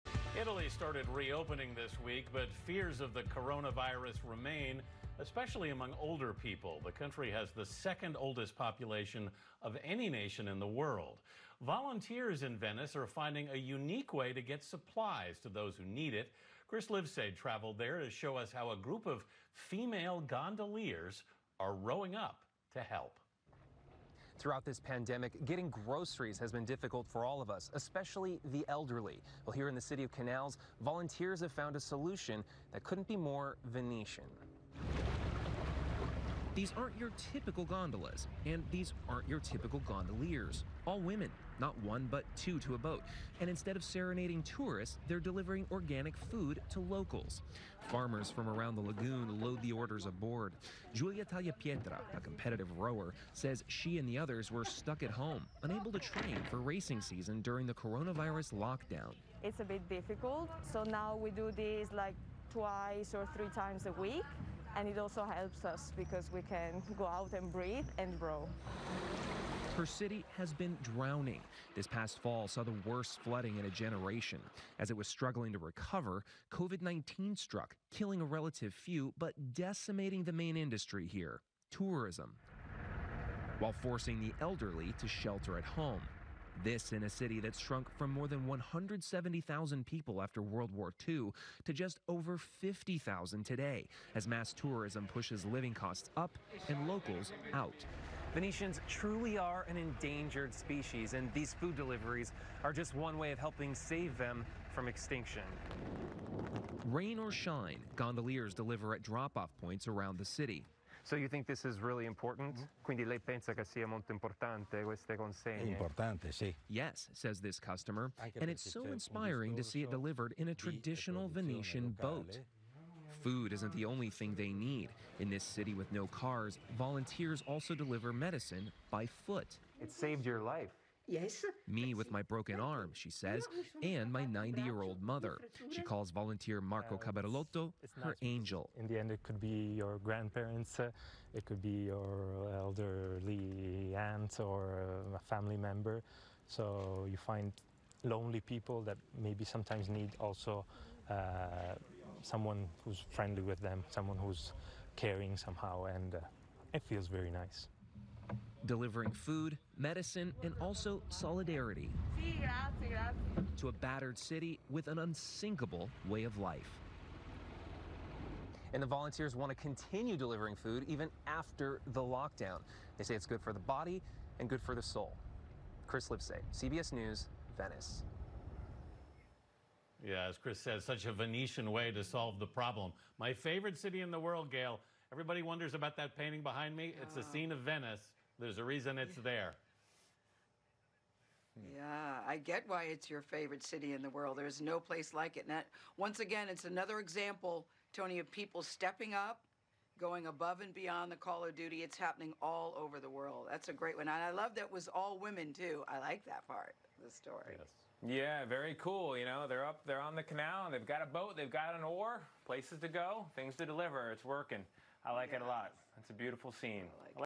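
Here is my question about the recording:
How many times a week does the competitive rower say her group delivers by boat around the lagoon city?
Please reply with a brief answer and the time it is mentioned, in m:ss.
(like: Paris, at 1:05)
2 or 3, at 1:02.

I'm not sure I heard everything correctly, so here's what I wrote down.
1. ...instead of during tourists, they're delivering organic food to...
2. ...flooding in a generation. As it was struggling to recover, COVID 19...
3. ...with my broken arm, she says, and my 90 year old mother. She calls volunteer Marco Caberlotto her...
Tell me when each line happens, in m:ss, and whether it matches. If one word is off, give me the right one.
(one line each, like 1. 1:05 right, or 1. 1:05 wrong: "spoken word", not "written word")
1. 0:43 wrong: "serenading", not "during"
2. 1:13 right
3. 2:11 right.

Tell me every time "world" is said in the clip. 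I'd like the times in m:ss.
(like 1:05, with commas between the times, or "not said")
0:10, 1:30, 3:04, 3:14, 3:23.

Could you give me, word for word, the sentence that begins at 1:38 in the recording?
Venetians truly are an endangered species, and these food deliveries are just one way of helping save them from extinction.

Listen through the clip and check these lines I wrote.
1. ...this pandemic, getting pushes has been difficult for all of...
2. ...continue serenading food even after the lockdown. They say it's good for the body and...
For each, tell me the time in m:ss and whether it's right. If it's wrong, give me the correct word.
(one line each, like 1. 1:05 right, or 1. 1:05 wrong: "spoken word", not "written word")
1. 0:24 wrong: "groceries", not "pushes"
2. 2:49 wrong: "delivering", not "serenading".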